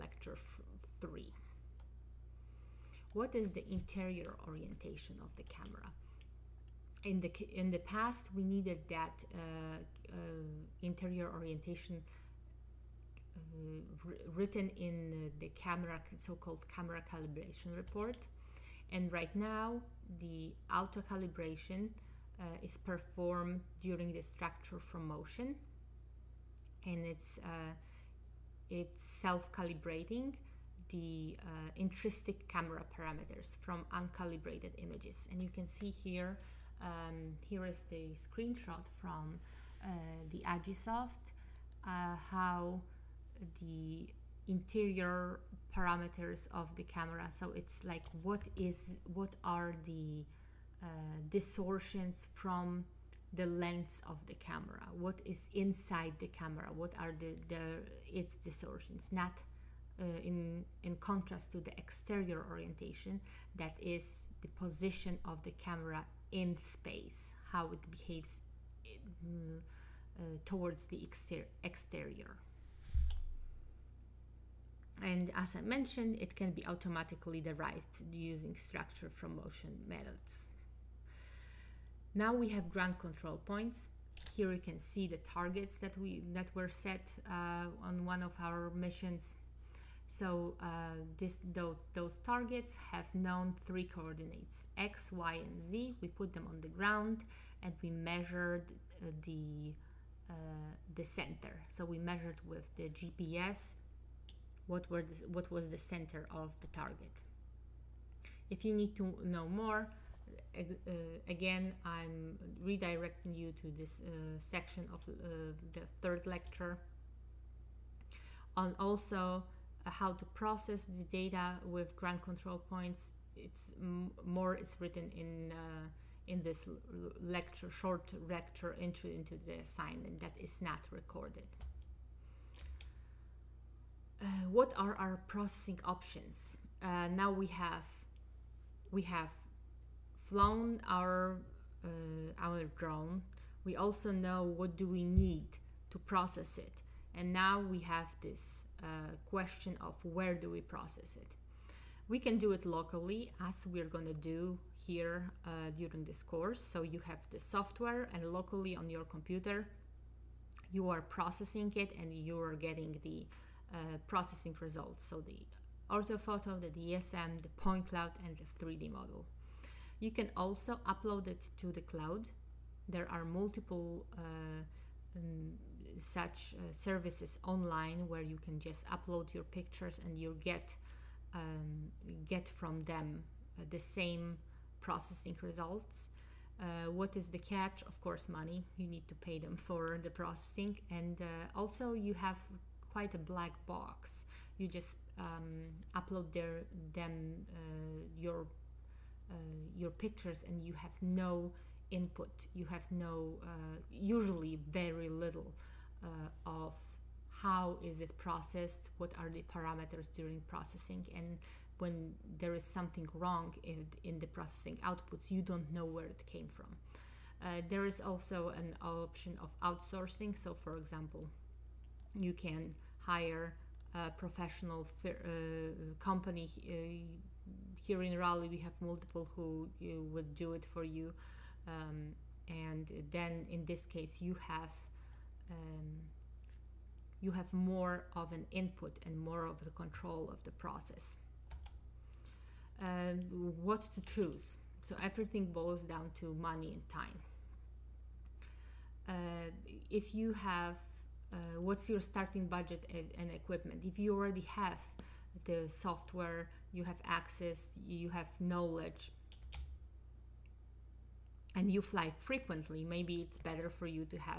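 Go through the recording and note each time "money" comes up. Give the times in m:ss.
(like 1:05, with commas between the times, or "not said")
3:08, 4:06.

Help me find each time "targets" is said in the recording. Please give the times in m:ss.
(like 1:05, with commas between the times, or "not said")
1:25, 1:32, 1:46.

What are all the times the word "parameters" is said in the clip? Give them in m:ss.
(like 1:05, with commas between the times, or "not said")
0:32, 0:45, 3:29.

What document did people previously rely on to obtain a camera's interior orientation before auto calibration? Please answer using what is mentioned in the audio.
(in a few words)
Camera calibration report.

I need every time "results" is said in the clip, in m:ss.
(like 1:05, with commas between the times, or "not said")
2:44, 3:05.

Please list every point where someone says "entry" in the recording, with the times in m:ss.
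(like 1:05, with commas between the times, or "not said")
2:08.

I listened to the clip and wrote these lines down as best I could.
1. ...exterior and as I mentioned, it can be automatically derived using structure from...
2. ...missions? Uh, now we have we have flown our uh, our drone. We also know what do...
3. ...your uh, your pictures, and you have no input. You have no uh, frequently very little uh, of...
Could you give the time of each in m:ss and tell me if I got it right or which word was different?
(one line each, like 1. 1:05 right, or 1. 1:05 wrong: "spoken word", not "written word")
1. 1:11 right
2. 2:15 wrong: "options", not "missions"
3. 3:18 wrong: "usually", not "frequently".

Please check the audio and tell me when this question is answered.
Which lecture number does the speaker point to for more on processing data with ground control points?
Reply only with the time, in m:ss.
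1:56.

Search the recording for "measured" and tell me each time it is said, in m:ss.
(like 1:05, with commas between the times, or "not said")
1:37, 1:41.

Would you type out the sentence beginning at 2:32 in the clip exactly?
We can do it locally as we're going to do here uh, during this course.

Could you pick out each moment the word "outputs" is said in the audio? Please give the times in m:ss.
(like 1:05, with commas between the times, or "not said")
3:34.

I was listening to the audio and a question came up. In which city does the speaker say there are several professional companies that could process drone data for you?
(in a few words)
Raleigh.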